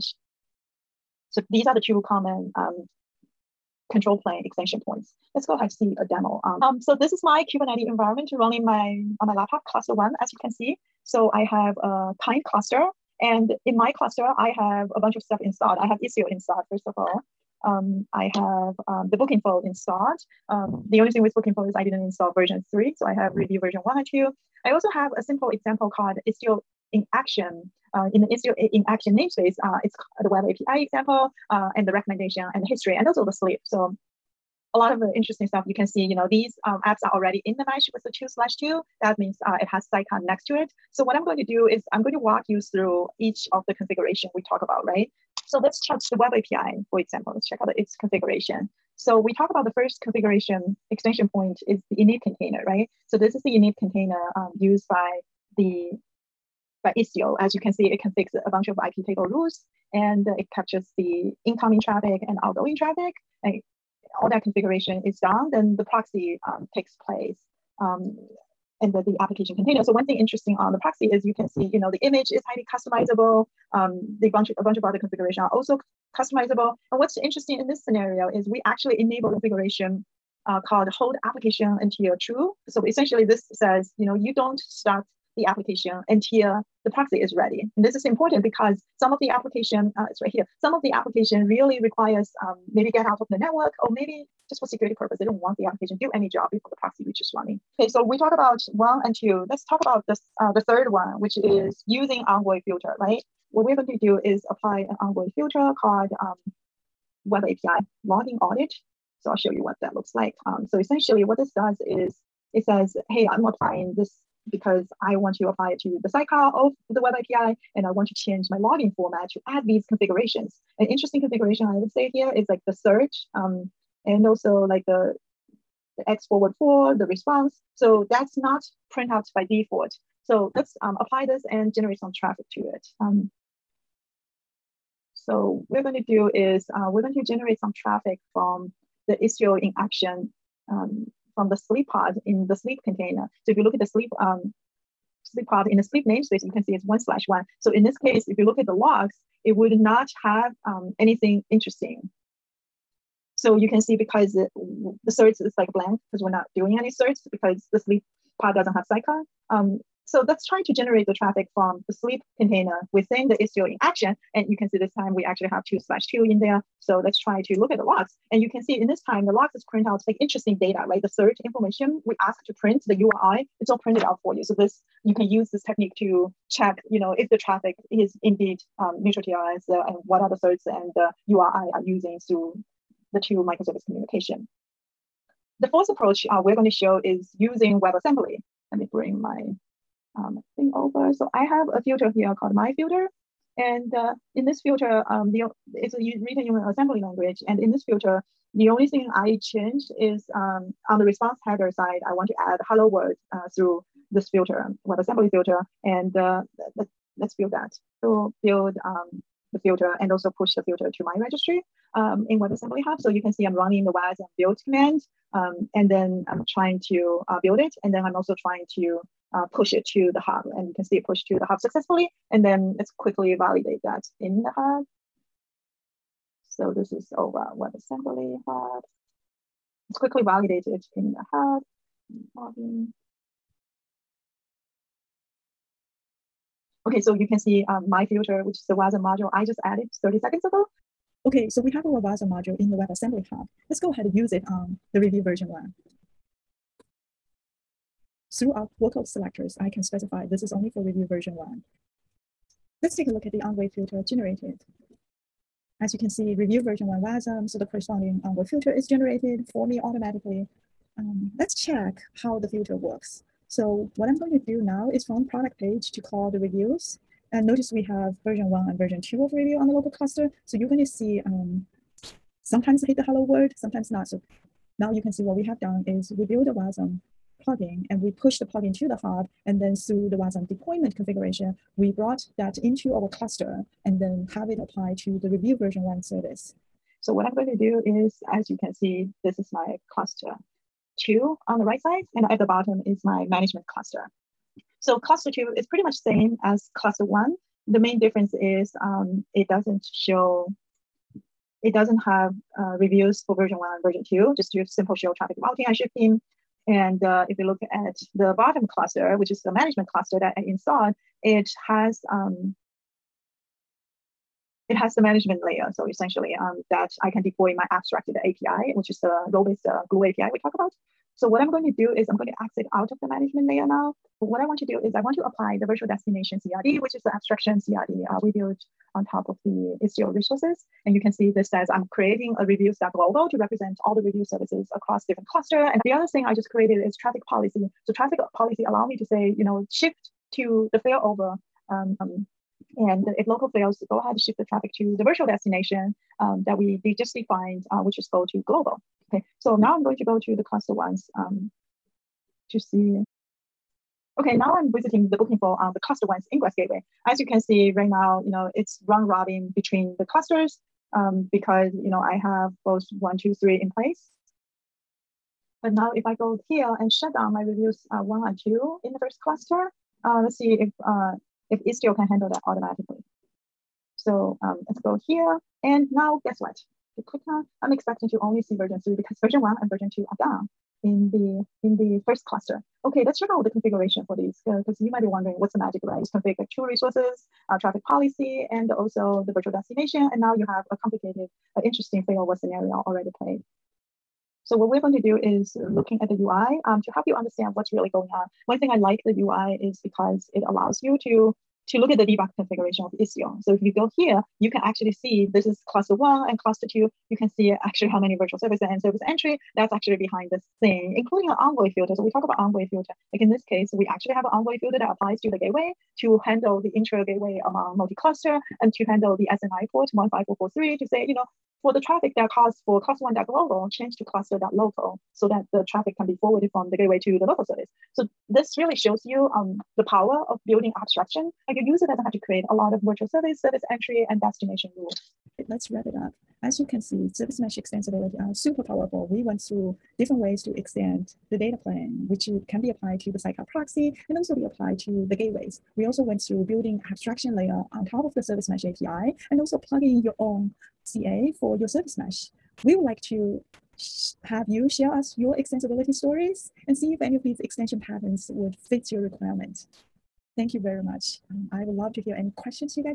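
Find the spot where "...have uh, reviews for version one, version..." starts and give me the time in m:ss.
5:02.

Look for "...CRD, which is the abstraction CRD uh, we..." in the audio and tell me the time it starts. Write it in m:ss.
5:26.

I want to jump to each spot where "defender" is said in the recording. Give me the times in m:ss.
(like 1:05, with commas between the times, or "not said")
not said.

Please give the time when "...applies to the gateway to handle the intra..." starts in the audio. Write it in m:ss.
6:54.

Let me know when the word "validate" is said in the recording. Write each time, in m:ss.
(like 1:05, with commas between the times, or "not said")
3:43, 3:50.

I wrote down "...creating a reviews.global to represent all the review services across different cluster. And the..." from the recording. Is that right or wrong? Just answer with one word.
right.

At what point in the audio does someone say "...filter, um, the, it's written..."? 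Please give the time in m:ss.
3:14.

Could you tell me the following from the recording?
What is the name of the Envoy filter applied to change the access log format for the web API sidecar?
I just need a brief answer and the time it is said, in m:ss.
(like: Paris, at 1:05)
Web API logging audit, at 1:47.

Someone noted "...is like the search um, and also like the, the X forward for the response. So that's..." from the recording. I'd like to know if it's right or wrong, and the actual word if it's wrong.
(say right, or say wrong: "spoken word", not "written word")
right.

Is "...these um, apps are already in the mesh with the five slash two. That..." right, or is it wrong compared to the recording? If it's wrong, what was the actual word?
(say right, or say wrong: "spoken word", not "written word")
wrong: "two", not "five".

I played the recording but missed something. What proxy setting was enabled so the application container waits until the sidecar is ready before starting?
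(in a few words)
hold application until true.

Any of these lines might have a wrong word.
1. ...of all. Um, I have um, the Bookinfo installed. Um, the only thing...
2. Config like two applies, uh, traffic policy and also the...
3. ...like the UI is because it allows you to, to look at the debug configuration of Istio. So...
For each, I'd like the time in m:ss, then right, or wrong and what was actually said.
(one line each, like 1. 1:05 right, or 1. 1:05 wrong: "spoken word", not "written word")
1. 0:16 right
2. 6:26 wrong: "resources", not "applies"
3. 6:38 right.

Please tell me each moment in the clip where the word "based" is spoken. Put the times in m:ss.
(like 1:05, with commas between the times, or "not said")
5:19.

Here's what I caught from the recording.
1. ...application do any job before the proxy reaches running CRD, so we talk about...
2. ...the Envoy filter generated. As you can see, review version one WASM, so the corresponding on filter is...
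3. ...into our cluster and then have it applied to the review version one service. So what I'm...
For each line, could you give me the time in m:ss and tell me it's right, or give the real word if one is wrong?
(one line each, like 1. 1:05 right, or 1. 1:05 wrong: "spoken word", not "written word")
1. 1:35 wrong: "Okay", not "CRD"
2. 4:13 right
3. 4:42 right.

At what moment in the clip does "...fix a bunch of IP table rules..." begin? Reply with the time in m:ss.
0:58.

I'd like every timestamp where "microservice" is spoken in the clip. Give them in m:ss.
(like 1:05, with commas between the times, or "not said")
3:03.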